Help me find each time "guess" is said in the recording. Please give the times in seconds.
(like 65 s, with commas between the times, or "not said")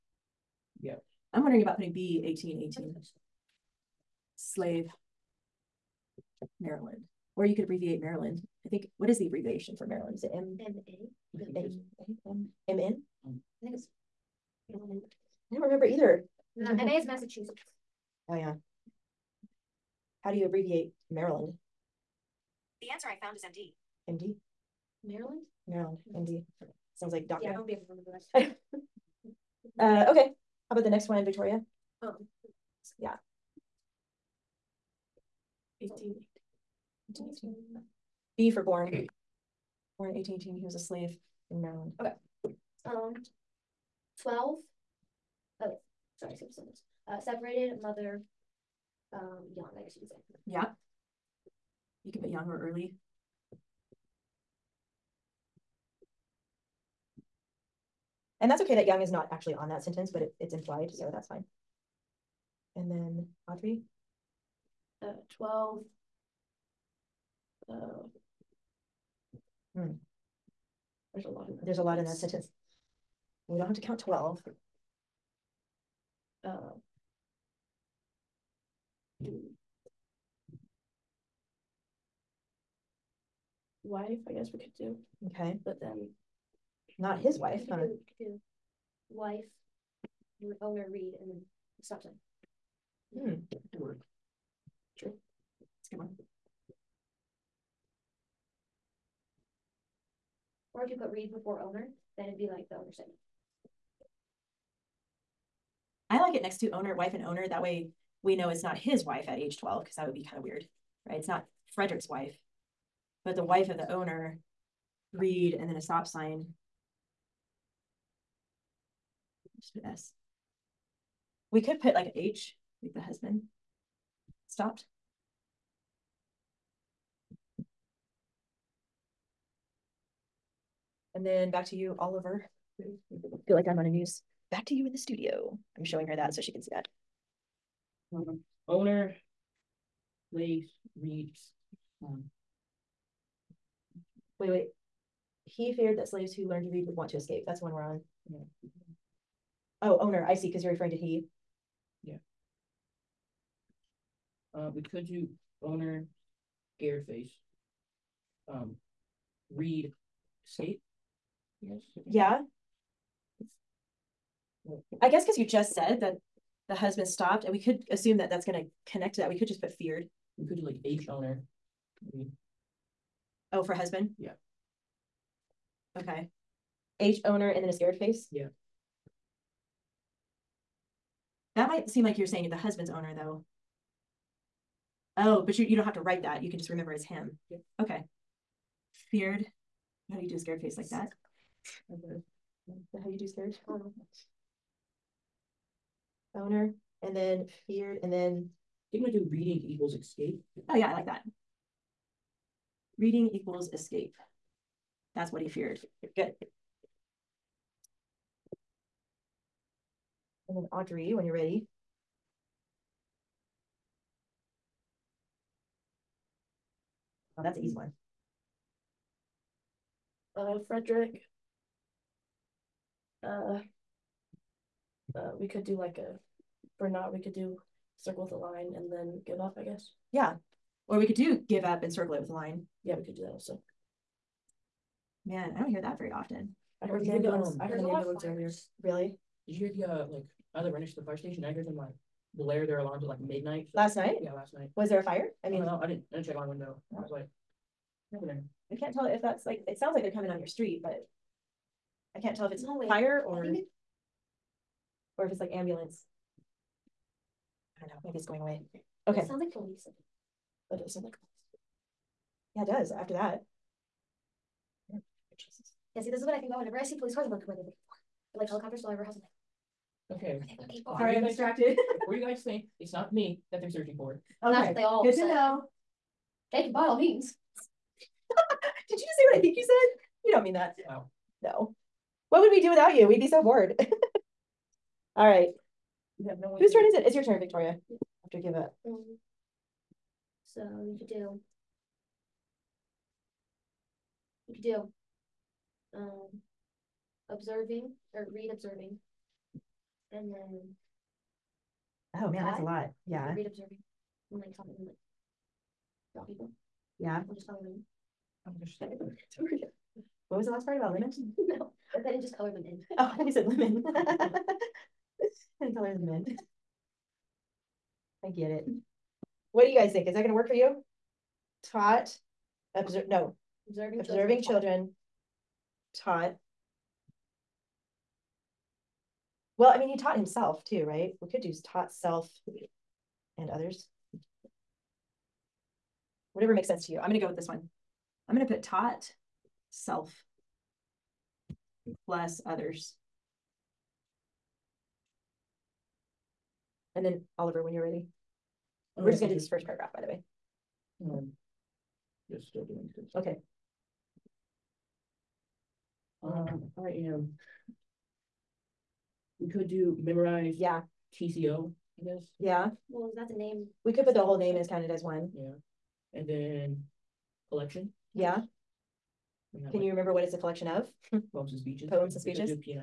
49 s, 84 s, 165 s, 229 s, 362 s.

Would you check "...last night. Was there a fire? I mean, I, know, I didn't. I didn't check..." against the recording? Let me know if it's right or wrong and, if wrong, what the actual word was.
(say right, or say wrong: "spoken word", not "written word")
right.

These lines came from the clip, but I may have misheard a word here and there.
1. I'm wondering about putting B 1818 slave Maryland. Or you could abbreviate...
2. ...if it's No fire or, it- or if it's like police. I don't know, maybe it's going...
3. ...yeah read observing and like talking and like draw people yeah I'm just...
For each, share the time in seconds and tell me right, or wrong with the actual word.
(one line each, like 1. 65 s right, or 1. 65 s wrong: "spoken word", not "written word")
1. 1 s right
2. 252 s wrong: "ambulance", not "police"
3. 303 s right.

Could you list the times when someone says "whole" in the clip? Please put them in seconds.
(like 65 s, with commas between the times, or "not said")
364 s.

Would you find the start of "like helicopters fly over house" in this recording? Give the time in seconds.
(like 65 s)
268 s.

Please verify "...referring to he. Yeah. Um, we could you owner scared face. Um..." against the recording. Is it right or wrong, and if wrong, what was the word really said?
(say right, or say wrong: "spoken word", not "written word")
right.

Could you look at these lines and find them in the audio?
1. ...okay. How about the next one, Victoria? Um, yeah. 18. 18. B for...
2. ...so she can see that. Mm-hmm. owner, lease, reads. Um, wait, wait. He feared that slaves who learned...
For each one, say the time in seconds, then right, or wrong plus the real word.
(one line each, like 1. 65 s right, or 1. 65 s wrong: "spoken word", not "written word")
1. 30 s right
2. 136 s right.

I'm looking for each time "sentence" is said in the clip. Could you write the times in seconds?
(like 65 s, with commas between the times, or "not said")
46 s, 59 s, 72 s.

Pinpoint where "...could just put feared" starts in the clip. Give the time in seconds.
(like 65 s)
169 s.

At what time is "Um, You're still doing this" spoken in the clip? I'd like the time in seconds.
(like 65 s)
351 s.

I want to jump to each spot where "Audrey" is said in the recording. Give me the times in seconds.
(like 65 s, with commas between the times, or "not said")
63 s, 210 s.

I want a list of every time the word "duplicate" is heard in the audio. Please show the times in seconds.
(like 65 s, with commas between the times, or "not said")
not said.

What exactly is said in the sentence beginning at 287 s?
It's your turn, Victoria have to give up.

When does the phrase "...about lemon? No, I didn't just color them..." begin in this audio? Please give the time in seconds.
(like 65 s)
310 s.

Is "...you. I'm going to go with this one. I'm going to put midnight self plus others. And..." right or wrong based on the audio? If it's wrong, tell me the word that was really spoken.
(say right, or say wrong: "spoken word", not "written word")
wrong: "taught", not "midnight".